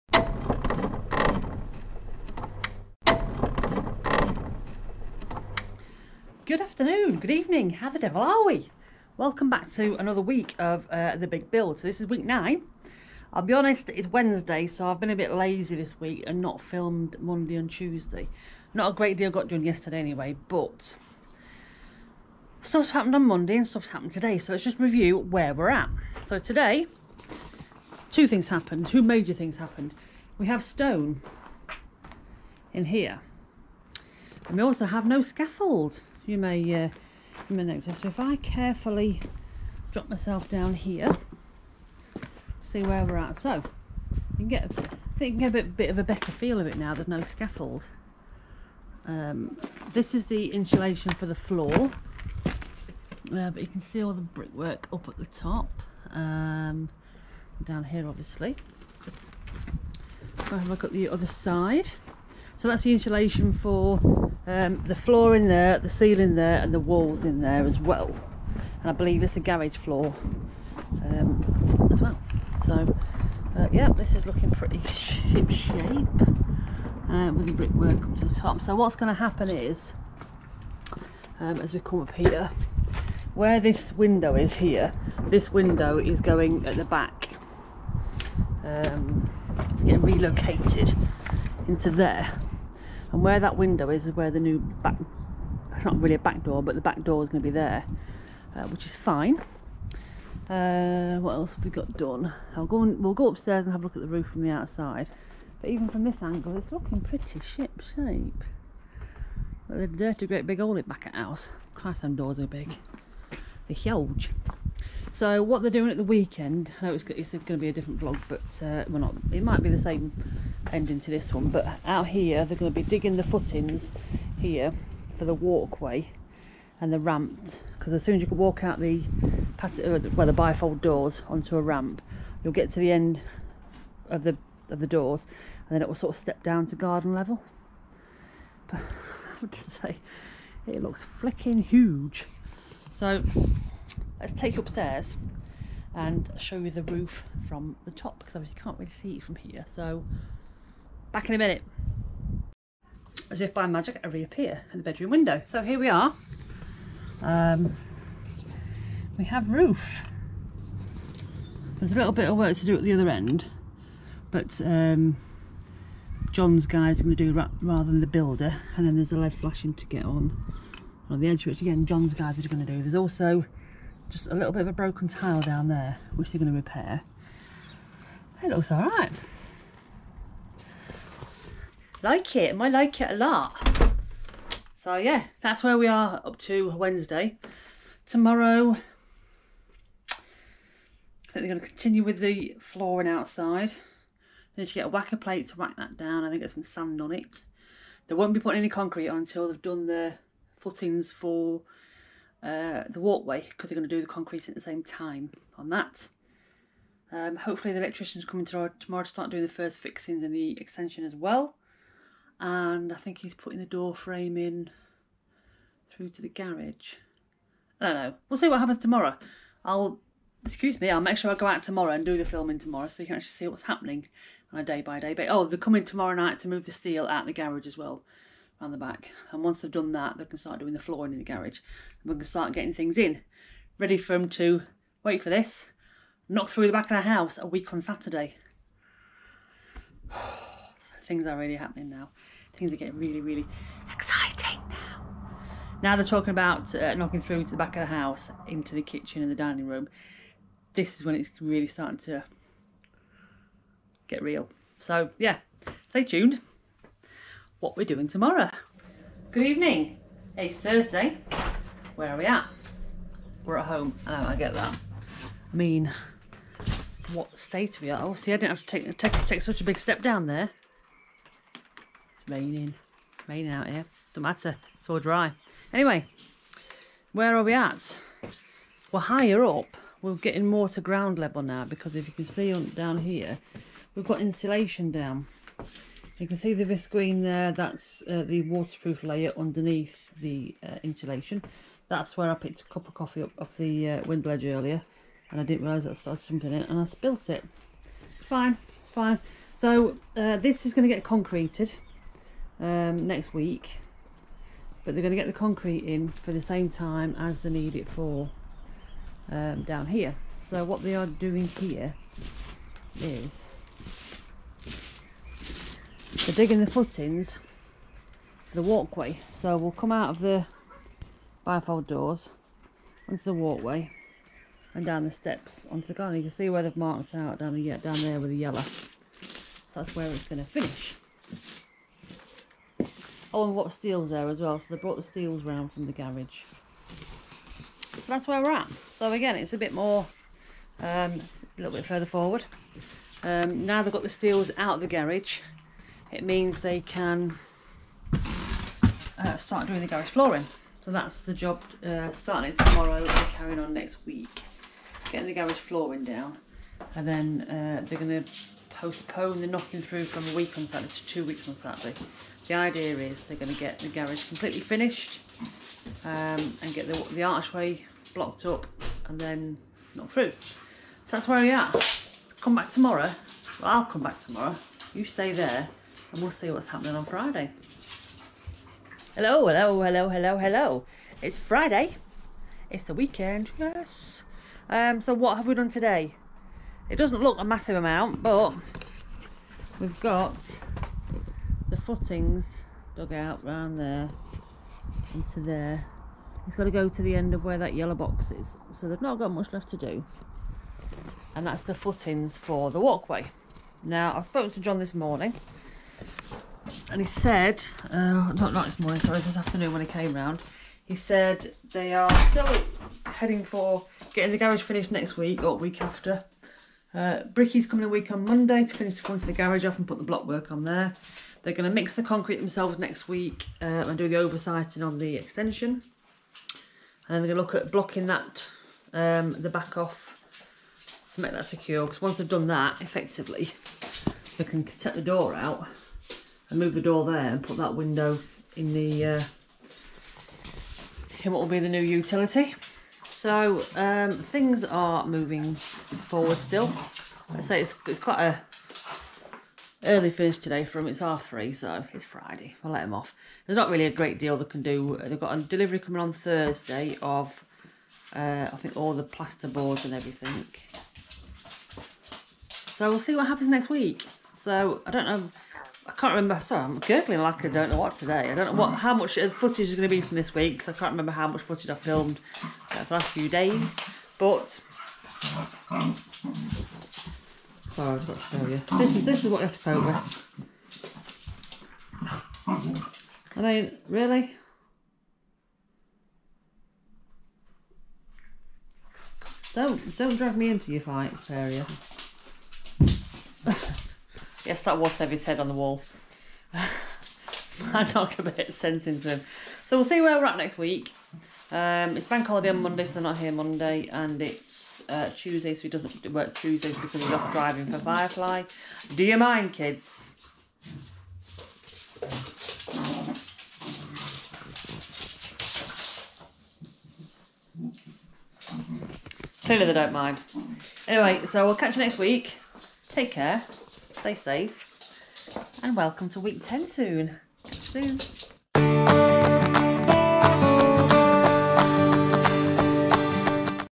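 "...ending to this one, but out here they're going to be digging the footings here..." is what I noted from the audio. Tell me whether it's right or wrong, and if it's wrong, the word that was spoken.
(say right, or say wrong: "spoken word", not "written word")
right.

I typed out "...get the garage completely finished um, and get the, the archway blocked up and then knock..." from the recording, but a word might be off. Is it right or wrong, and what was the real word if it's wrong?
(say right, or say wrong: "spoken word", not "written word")
right.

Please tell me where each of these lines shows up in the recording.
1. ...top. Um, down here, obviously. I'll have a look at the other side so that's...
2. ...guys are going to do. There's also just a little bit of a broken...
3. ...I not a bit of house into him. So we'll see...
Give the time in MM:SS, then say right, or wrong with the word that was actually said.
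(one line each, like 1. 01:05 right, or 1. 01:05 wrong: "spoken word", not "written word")
1. 00:55 right
2. 02:52 right
3. 08:16 wrong: "sense", not "house".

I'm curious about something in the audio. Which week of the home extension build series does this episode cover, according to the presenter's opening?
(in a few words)
9.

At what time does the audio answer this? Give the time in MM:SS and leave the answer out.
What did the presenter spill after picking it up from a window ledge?
04:52.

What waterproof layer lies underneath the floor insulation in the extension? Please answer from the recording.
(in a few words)
visqueen.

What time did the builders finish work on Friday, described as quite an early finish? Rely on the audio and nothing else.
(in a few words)
half three.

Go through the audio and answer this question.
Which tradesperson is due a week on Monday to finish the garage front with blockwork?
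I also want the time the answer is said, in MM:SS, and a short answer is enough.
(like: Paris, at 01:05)
Bricky, at 06:57.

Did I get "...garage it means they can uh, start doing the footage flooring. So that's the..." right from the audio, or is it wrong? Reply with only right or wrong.
wrong.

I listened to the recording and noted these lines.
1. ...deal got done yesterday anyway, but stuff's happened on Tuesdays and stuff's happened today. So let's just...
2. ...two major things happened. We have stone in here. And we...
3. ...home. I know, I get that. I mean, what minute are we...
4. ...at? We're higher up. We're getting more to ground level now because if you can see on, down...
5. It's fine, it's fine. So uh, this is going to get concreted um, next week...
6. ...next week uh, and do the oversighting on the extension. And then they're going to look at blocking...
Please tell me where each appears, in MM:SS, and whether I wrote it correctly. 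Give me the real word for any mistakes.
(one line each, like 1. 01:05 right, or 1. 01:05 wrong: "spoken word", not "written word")
1. 00:19 wrong: "Monday", not "Tuesdays"
2. 00:28 right
3. 04:23 wrong: "state", not "minute"
4. 04:37 right
5. 04:58 right
6. 07:02 right.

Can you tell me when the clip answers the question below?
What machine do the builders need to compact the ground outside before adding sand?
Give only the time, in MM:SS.
03:14.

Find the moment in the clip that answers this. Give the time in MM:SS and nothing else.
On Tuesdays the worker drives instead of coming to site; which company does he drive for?
08:27.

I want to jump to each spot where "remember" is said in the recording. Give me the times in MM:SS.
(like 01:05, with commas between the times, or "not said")
07:46, 07:50.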